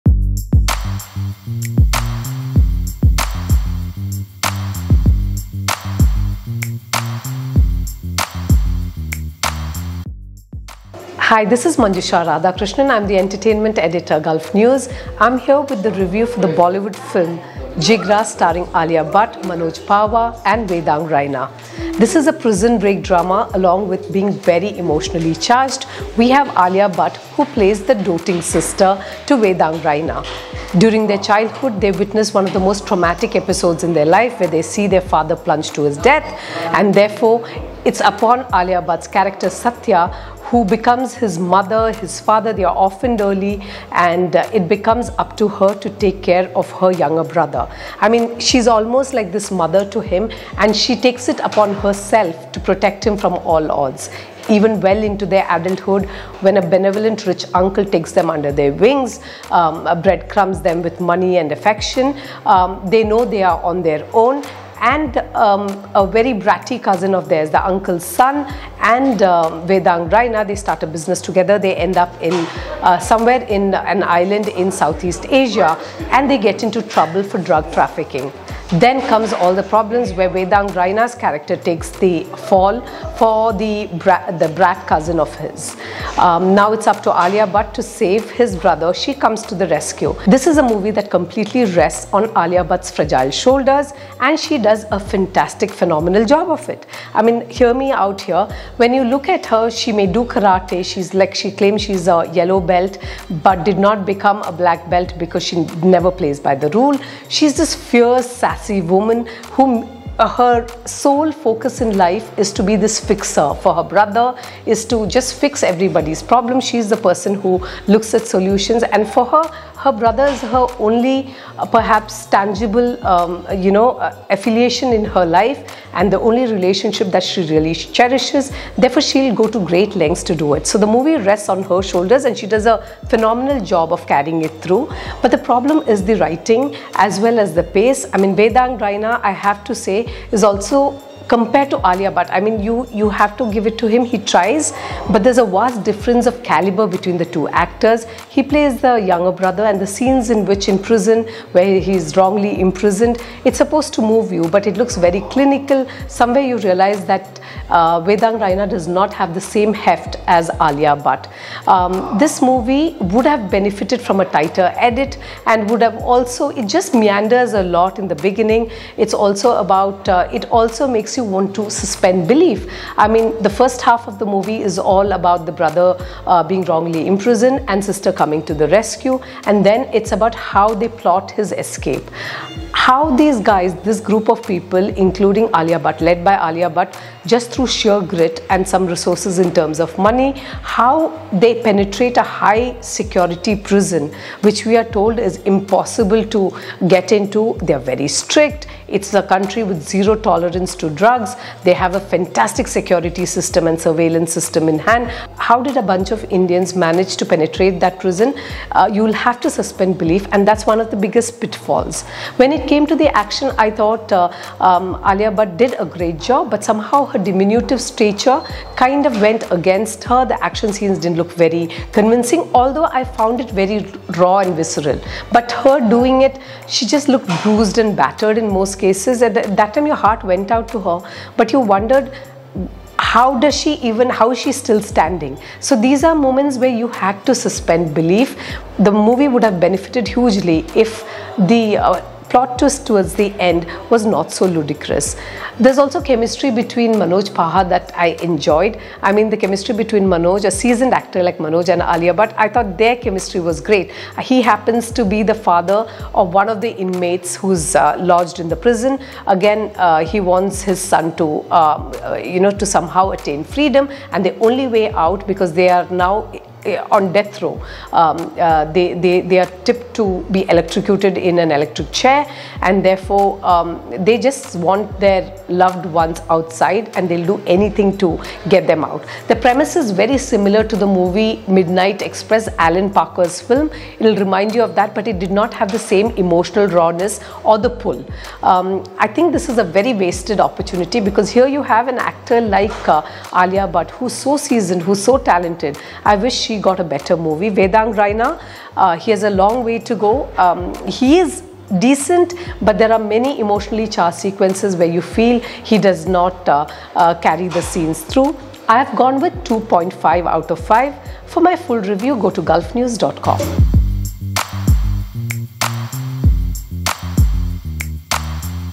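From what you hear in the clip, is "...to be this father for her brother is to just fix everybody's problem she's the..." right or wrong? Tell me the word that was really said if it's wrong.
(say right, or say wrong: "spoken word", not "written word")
wrong: "fixer", not "father".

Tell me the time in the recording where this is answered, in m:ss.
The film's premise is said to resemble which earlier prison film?
4:41.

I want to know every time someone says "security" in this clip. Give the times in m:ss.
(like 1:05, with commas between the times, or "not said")
3:12, 3:22.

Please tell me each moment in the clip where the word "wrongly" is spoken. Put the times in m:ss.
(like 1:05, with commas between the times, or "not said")
2:32, 2:56.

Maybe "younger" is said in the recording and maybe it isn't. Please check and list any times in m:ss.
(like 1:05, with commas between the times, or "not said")
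0:46, 2:29.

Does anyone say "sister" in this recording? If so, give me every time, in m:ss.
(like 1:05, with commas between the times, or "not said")
0:28, 2:57.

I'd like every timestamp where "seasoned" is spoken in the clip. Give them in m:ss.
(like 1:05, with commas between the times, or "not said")
4:10, 4:54.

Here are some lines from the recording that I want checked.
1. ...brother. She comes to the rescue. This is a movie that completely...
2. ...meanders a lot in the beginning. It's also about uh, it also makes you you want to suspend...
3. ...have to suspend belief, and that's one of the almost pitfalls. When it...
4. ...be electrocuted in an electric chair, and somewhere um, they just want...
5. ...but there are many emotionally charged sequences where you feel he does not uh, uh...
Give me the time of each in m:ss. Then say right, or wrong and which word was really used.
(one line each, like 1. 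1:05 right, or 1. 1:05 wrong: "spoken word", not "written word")
1. 1:28 right
2. 2:47 right
3. 3:29 wrong: "biggest", not "almost"
4. 4:30 wrong: "therefore", not "somewhere"
5. 5:02 right.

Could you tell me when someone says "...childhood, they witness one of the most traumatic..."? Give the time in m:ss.
0:31.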